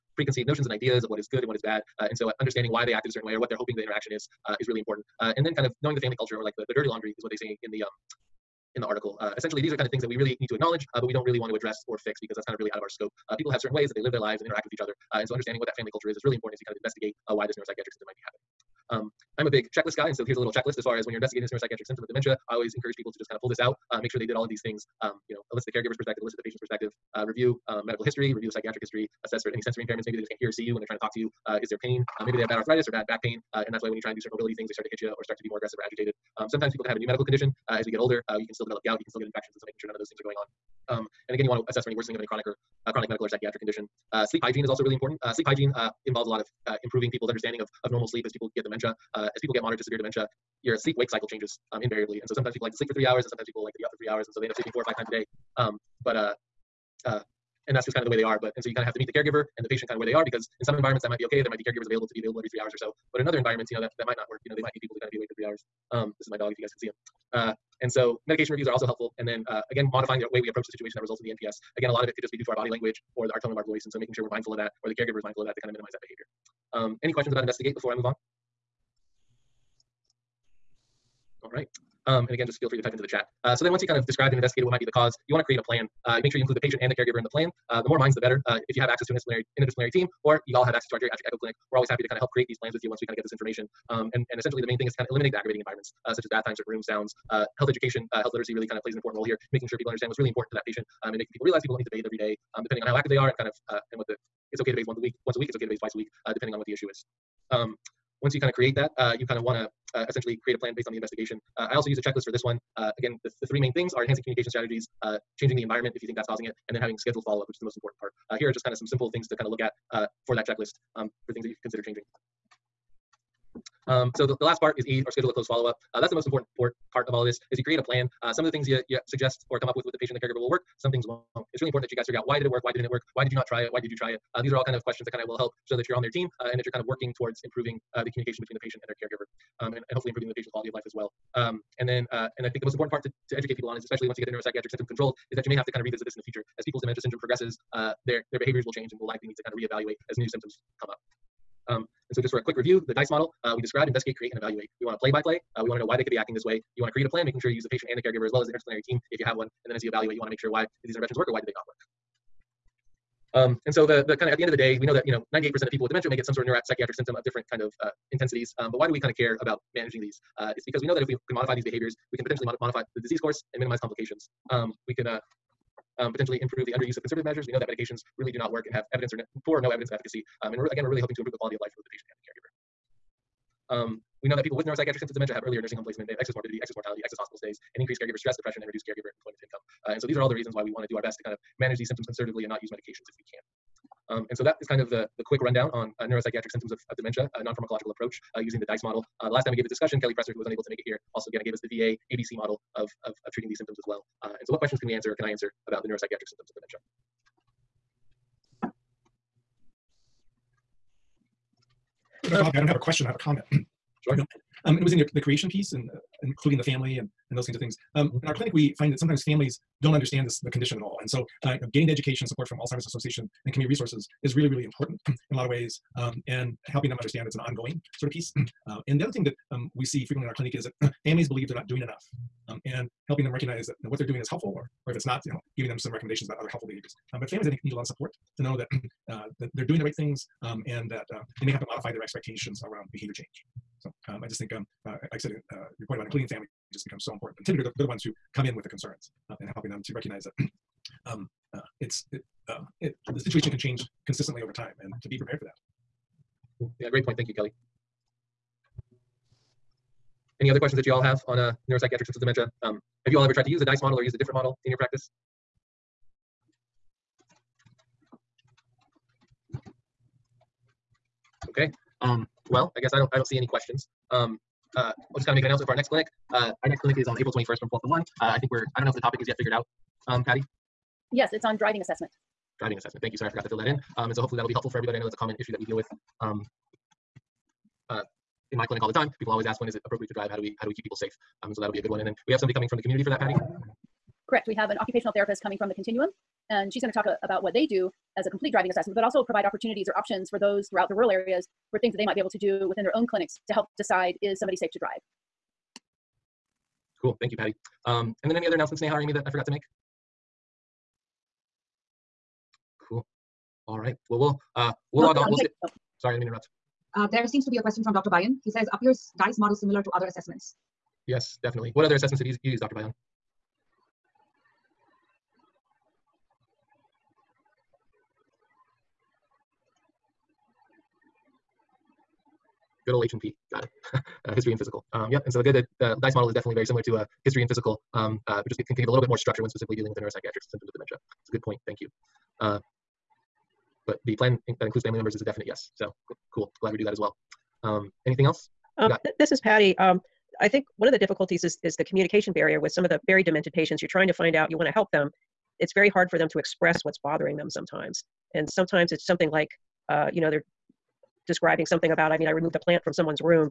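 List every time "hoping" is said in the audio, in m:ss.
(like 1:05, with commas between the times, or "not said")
0:03, 3:00.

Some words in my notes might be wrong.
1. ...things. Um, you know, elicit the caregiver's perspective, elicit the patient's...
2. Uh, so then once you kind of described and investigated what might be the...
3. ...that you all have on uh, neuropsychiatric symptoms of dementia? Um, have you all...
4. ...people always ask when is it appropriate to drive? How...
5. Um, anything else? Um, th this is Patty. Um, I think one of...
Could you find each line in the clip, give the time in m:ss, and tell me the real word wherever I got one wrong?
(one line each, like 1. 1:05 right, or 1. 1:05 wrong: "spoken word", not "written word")
1. 0:24 right
2. 1:23 right
3. 4:20 right
4. 4:49 right
5. 5:47 right.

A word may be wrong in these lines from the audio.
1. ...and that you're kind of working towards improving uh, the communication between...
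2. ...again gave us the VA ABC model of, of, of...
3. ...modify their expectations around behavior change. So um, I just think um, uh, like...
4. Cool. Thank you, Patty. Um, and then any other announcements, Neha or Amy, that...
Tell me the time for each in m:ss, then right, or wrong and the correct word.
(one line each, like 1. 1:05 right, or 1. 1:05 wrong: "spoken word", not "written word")
1. 2:16 right
2. 3:21 right
3. 4:01 right
4. 5:07 right.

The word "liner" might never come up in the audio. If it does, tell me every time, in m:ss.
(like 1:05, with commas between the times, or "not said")
not said.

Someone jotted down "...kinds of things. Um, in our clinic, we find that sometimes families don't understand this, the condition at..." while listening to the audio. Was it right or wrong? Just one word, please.
right.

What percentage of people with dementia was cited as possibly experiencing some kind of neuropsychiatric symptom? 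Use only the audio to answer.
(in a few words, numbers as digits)
98%.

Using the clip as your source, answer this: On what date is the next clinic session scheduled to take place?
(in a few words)
April 21st.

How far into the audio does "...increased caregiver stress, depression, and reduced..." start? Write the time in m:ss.
3:07.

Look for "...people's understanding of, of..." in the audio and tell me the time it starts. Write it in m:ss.
0:47.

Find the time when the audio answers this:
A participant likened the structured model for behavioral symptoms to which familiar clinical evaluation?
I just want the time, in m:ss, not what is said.
5:33.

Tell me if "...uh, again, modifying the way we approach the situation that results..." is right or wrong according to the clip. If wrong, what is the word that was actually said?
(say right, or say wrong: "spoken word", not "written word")
right.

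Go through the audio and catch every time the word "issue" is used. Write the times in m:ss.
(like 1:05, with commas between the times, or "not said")
1:46, 4:45.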